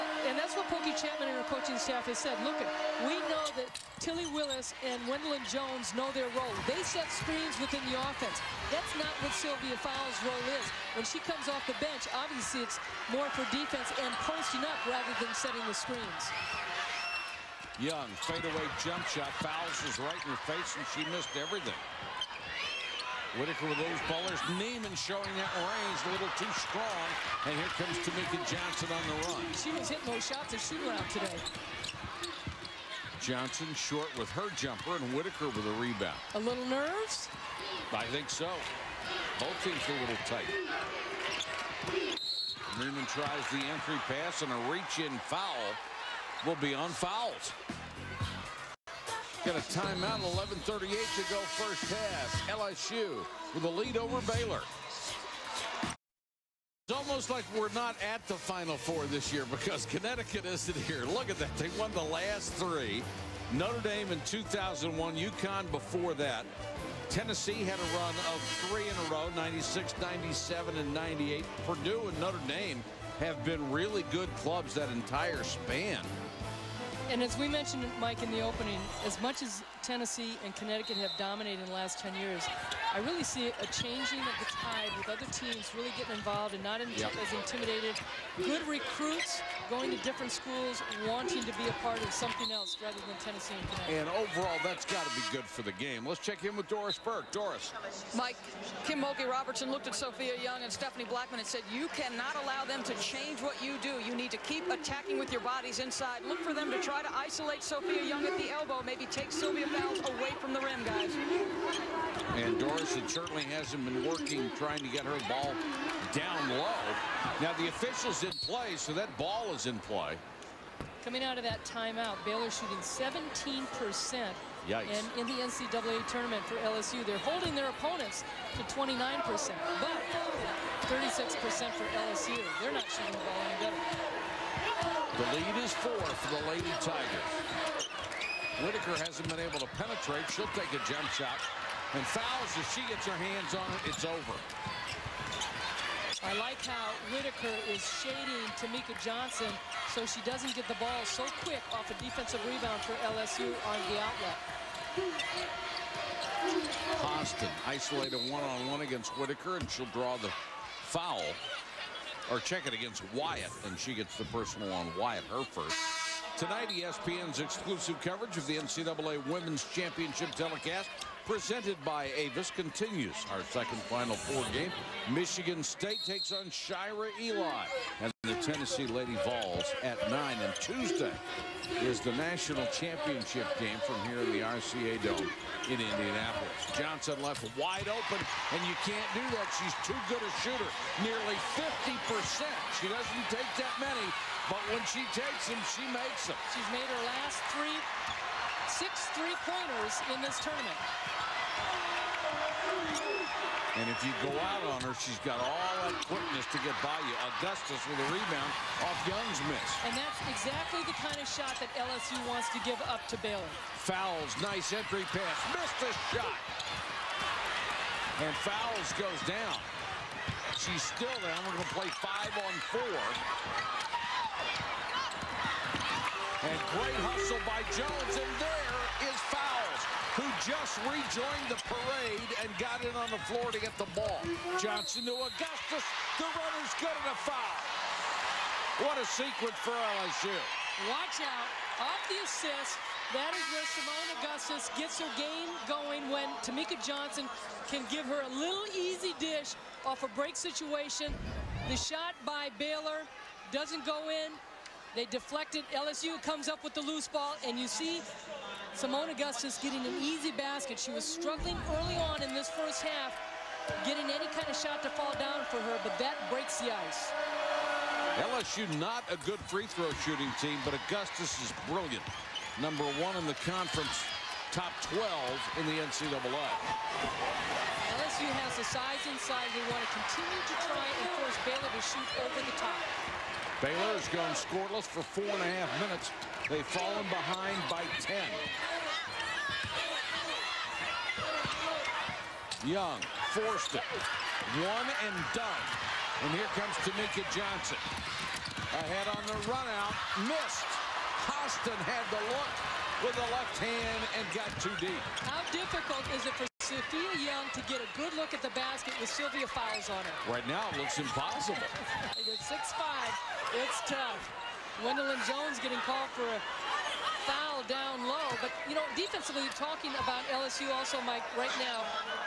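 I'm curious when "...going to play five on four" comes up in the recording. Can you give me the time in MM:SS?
03:41.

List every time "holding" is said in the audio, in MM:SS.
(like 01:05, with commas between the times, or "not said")
02:07.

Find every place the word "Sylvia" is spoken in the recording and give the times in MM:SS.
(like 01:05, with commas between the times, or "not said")
00:09, 01:49, 05:09.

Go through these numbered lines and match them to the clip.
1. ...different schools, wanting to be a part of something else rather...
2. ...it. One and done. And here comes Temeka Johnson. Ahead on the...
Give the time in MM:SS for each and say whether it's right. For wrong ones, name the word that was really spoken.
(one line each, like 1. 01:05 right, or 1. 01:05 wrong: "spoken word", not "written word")
1. 01:30 right
2. 04:53 right.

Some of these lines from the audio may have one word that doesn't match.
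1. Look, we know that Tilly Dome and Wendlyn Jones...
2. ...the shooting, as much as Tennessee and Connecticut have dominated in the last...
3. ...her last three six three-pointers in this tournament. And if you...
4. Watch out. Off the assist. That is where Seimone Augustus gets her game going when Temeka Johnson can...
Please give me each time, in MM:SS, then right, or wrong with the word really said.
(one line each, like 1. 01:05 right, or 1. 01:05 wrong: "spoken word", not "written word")
1. 00:02 wrong: "Willis", not "Dome"
2. 01:18 wrong: "opening", not "shooting"
3. 03:16 right
4. 04:00 right.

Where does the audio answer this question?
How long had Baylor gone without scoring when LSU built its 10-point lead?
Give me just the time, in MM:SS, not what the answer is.
04:45.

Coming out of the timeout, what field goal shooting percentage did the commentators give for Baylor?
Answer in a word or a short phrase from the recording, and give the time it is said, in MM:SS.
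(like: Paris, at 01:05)
17%, at 02:02.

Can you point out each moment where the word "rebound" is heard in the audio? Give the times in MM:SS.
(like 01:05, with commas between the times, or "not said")
00:35, 02:32, 03:28.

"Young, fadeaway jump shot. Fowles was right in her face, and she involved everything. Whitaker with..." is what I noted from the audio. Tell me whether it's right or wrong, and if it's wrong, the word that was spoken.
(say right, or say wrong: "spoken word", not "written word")
wrong: "missed", not "involved".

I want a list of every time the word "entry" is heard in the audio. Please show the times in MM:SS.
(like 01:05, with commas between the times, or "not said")
00:43, 03:34.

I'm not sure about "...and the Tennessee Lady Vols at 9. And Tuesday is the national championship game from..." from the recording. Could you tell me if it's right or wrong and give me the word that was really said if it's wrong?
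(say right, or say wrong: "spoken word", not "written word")
right.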